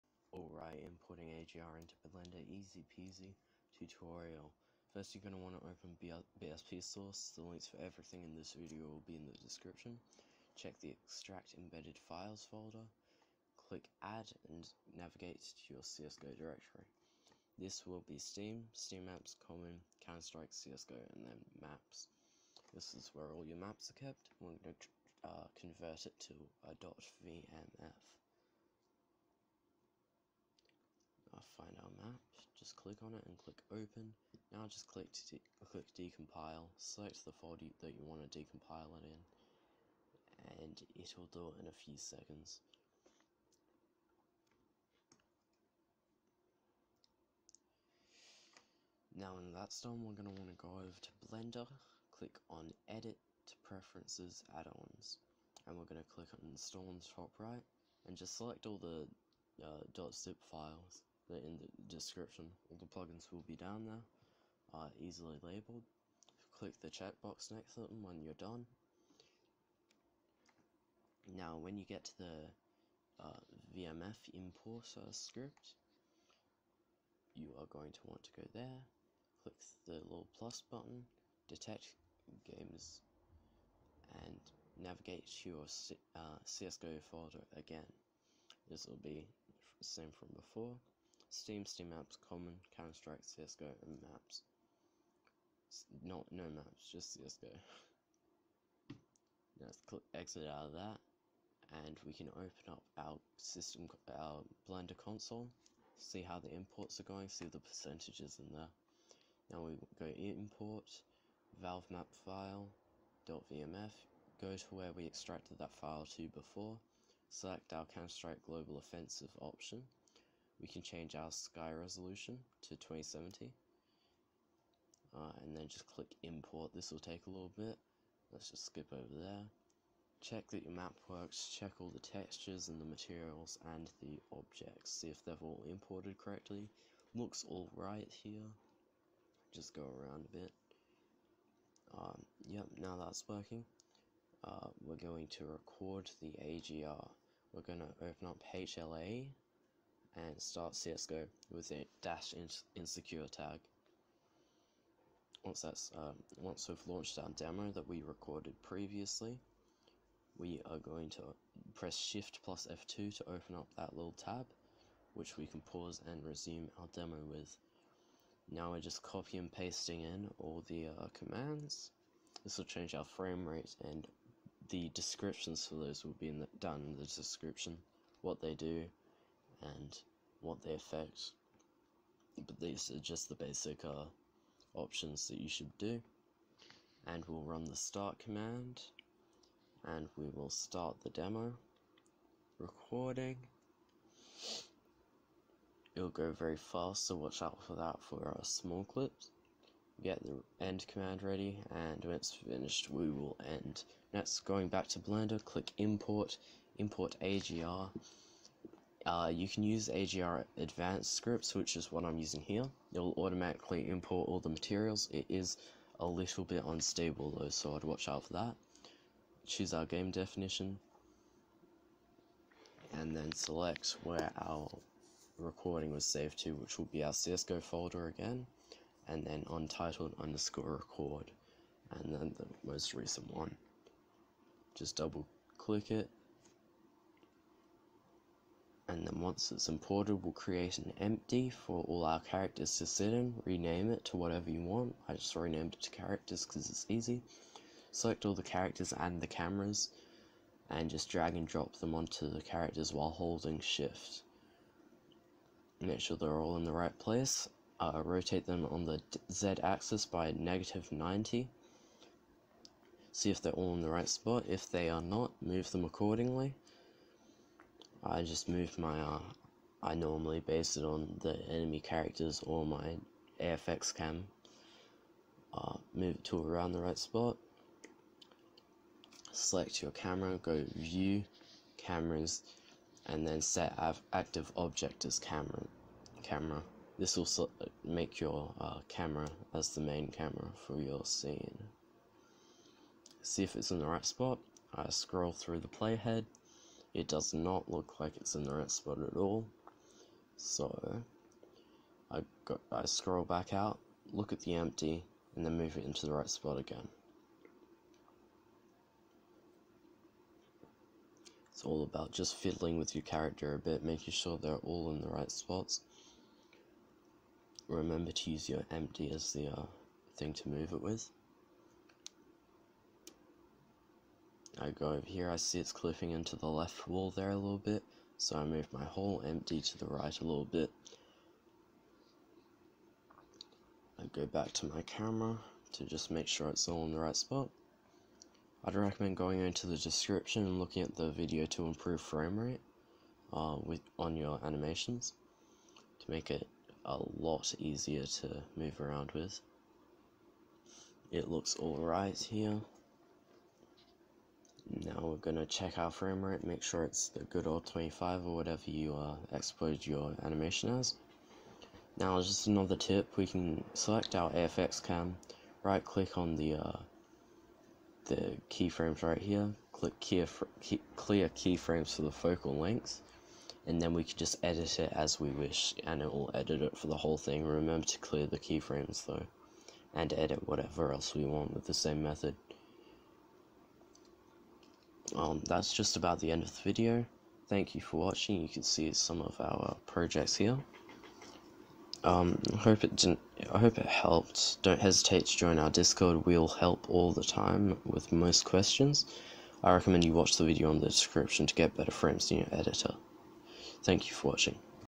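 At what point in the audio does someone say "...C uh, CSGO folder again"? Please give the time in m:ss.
1:25.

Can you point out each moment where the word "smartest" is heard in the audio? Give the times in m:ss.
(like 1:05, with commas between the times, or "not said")
not said.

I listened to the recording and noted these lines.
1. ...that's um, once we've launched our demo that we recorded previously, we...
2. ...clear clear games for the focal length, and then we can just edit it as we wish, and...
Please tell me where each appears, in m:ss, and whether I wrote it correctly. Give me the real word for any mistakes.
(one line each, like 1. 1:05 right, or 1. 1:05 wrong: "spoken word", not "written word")
1. 2:35 right
2. 6:09 wrong: "keyframes", not "games".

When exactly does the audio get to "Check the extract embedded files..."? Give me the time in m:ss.
0:10.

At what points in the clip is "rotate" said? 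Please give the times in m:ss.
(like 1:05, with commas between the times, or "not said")
4:18.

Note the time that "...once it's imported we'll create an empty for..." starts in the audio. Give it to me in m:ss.
3:59.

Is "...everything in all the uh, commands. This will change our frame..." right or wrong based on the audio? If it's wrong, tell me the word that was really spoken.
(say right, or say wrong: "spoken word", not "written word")
wrong: "pasting", not "everything".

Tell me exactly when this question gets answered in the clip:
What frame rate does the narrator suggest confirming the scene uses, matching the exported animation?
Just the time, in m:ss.
5:57.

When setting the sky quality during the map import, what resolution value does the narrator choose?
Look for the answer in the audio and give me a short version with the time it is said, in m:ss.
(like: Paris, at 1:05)
2070, at 2:02.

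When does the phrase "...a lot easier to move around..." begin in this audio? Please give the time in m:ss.
5:46.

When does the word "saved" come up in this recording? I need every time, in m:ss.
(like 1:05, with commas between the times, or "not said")
3:46.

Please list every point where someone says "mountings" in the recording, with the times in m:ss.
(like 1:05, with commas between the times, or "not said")
not said.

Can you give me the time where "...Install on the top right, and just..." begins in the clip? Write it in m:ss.
0:56.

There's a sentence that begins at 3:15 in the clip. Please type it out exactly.
It'll go very fast, so watch out for that for our uh, small clips.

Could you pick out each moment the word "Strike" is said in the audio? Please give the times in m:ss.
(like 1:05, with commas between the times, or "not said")
0:20, 1:32, 1:57.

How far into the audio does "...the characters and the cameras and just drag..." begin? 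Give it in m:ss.
4:08.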